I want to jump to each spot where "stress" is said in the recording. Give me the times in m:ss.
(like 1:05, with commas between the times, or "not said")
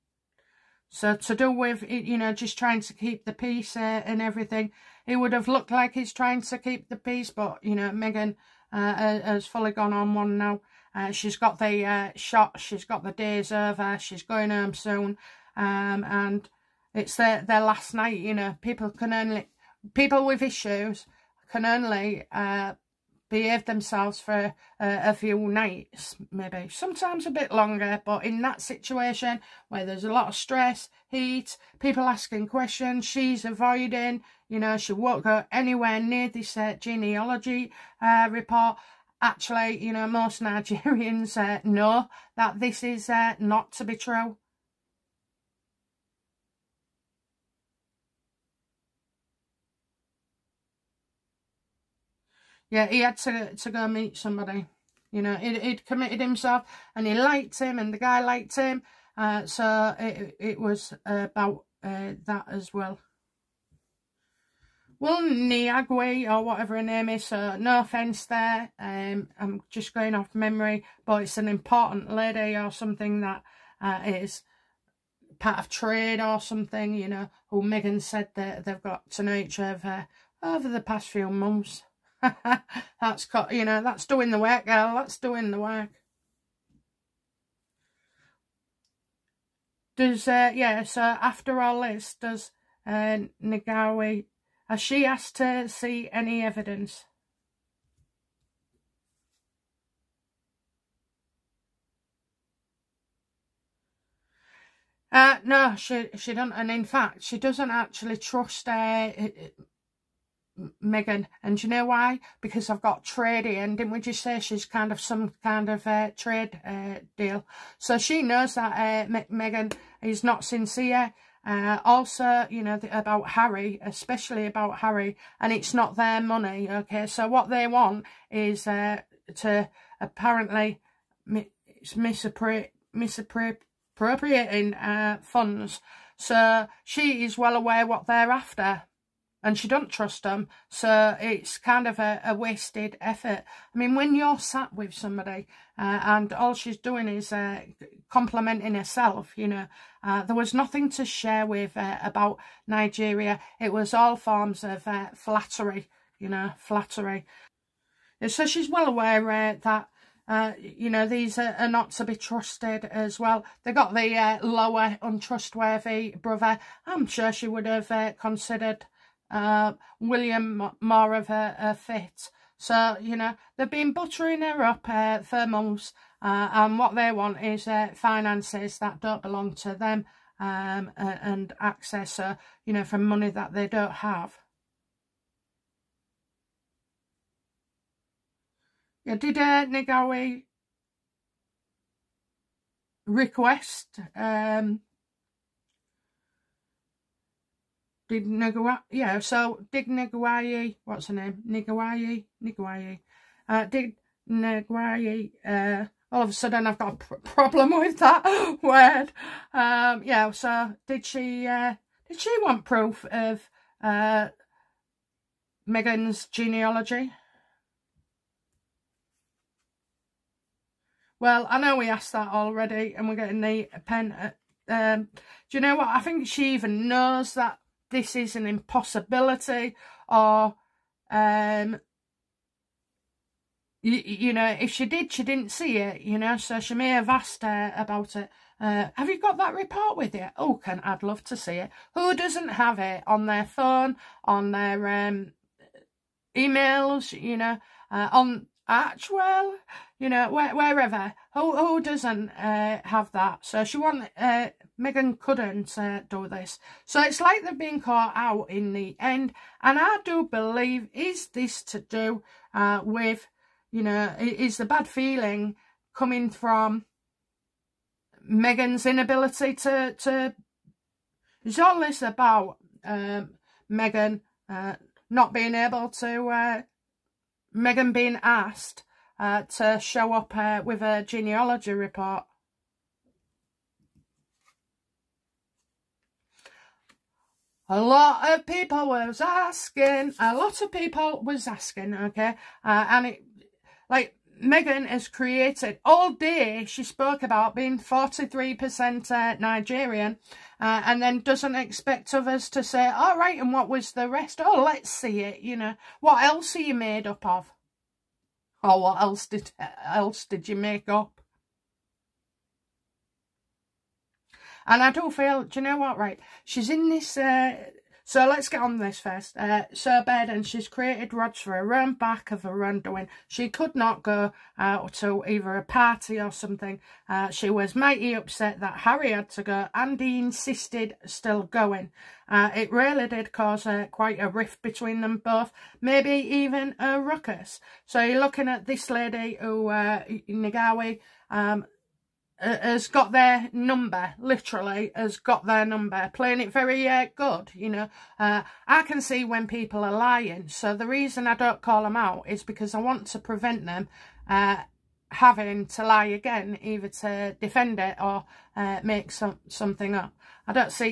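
0:30.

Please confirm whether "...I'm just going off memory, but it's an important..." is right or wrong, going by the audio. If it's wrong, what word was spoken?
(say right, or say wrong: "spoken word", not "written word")
right.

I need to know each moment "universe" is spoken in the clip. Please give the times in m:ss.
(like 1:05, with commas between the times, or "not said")
not said.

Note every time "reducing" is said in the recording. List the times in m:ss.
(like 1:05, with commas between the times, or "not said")
not said.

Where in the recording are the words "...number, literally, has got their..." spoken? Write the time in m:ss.
5:43.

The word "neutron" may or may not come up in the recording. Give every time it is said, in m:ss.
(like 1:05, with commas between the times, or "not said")
not said.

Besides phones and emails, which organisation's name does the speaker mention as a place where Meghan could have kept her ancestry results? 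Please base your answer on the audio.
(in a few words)
Archewell.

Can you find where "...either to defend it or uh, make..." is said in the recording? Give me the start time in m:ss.
5:56.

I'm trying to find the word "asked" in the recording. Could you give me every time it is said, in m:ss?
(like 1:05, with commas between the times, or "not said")
1:35, 3:41, 3:57, 4:38.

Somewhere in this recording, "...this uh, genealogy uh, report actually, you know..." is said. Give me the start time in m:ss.
0:36.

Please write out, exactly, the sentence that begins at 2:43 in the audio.
They got the uh, lower untrustworthy brother.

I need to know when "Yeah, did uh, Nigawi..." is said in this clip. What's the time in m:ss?
3:09.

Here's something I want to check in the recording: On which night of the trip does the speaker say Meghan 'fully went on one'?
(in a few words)
Their last night.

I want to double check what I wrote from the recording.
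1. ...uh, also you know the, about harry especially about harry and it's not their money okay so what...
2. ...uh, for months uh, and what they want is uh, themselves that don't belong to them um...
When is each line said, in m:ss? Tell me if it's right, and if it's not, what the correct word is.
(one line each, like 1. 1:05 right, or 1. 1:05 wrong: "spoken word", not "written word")
1. 2:01 right
2. 2:54 wrong: "finances", not "themselves".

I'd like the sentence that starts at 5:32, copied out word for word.
Uh, it really did cause uh, quite a rift between them both, maybe even a ruckus.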